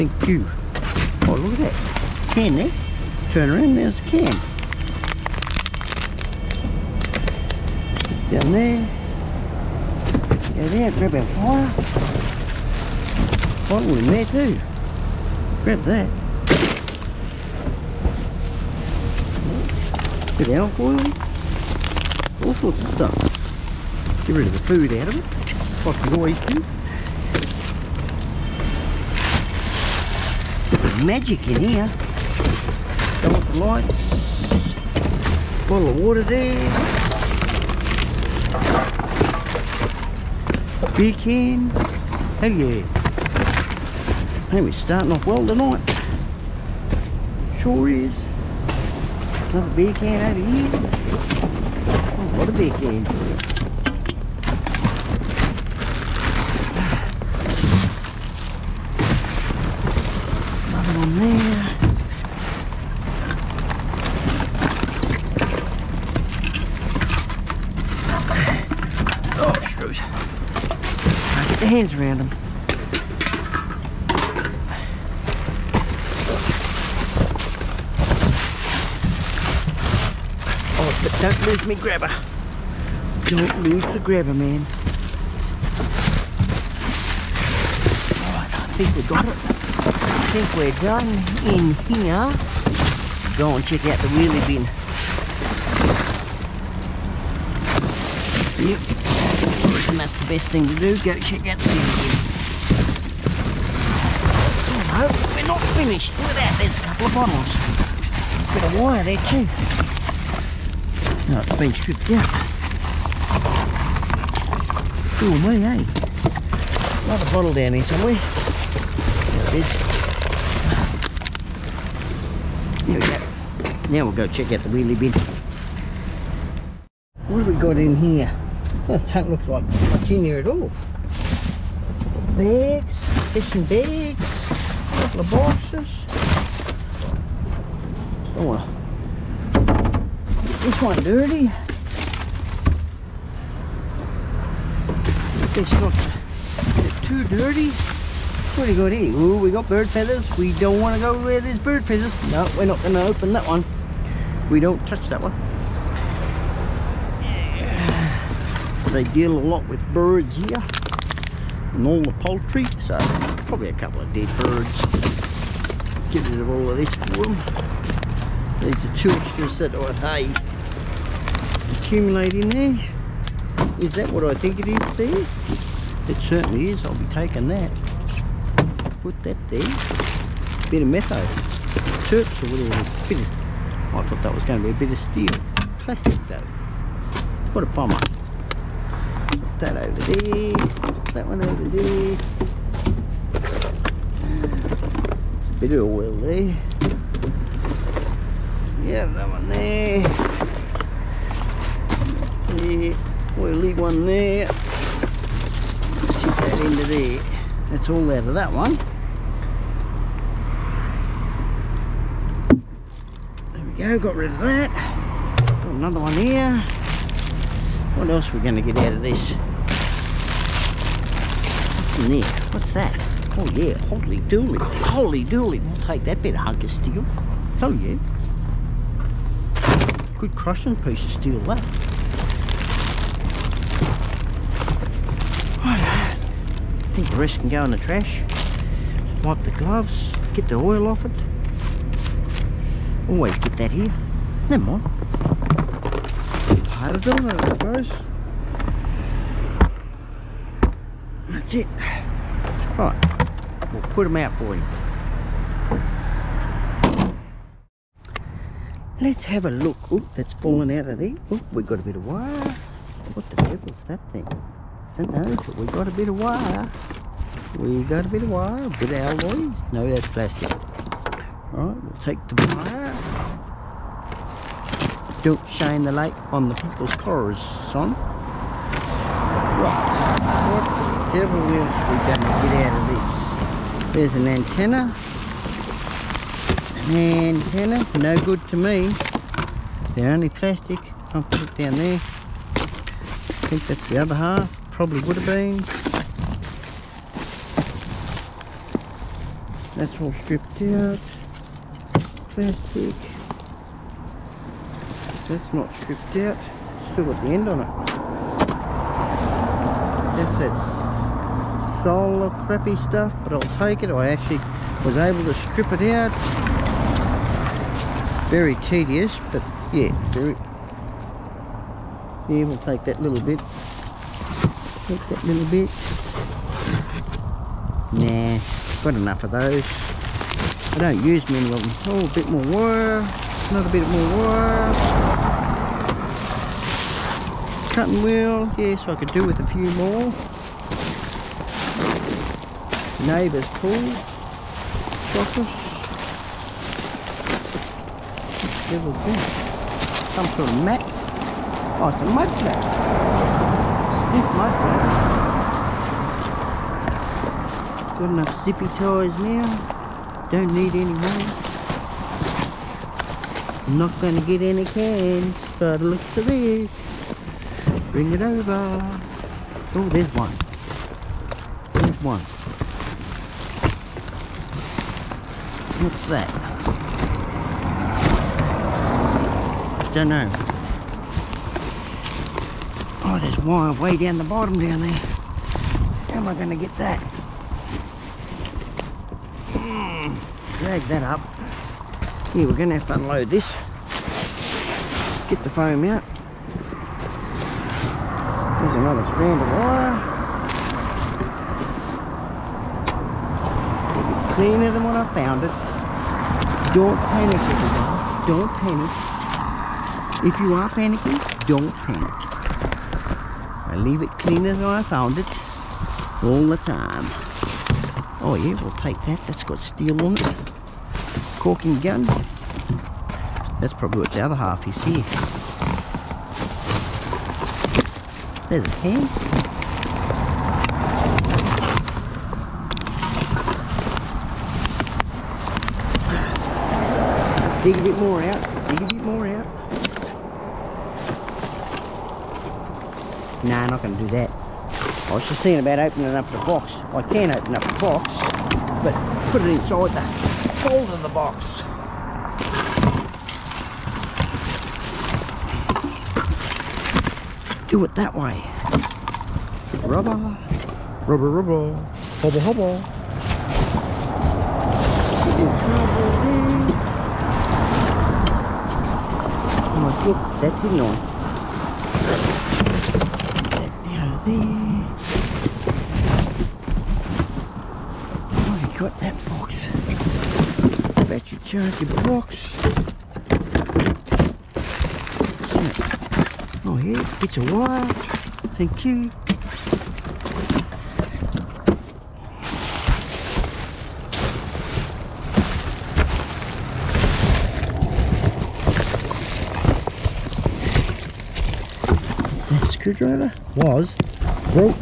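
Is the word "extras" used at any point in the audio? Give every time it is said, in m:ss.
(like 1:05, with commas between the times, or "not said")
2:49.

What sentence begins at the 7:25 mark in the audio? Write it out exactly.
I was just thinking about opening up the box.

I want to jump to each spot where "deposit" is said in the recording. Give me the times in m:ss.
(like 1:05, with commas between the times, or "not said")
not said.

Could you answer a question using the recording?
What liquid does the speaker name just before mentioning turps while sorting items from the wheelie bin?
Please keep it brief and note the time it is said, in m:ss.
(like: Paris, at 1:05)
metho, at 3:00.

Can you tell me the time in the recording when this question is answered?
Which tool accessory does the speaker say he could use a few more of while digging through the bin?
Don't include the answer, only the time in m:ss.
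5:37.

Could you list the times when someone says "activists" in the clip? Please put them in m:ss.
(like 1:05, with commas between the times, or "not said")
not said.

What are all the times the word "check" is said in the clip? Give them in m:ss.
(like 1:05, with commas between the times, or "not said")
1:33, 1:41, 2:04.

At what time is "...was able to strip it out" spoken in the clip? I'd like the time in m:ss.
5:14.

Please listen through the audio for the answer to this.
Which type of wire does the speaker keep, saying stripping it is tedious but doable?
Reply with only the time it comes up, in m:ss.
5:11.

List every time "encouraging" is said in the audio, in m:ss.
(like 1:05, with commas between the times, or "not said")
not said.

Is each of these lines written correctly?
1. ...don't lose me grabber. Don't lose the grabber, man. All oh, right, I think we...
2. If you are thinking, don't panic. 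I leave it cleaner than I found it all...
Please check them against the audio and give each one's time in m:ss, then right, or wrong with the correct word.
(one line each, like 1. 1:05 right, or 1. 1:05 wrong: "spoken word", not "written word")
1. 1:21 right
2. 6:50 wrong: "panicking", not "thinking".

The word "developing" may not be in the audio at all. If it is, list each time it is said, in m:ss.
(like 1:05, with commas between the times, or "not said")
not said.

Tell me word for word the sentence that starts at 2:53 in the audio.
Is that what I think it is there?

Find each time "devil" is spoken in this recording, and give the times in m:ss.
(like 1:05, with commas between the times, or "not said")
4:23, 4:41, 5:48.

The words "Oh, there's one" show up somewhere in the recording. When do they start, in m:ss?
6:09.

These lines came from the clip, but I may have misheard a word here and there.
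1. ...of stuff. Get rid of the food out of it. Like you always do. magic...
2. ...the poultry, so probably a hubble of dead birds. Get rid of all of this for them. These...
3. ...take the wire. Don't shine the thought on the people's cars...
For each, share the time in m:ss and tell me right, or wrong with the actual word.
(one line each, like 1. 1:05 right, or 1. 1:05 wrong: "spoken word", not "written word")
1. 0:22 right
2. 2:42 wrong: "couple", not "hubble"
3. 4:32 wrong: "light", not "thought".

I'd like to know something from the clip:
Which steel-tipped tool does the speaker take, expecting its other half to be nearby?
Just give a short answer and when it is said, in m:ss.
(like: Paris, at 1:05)
Caulking gun, at 7:01.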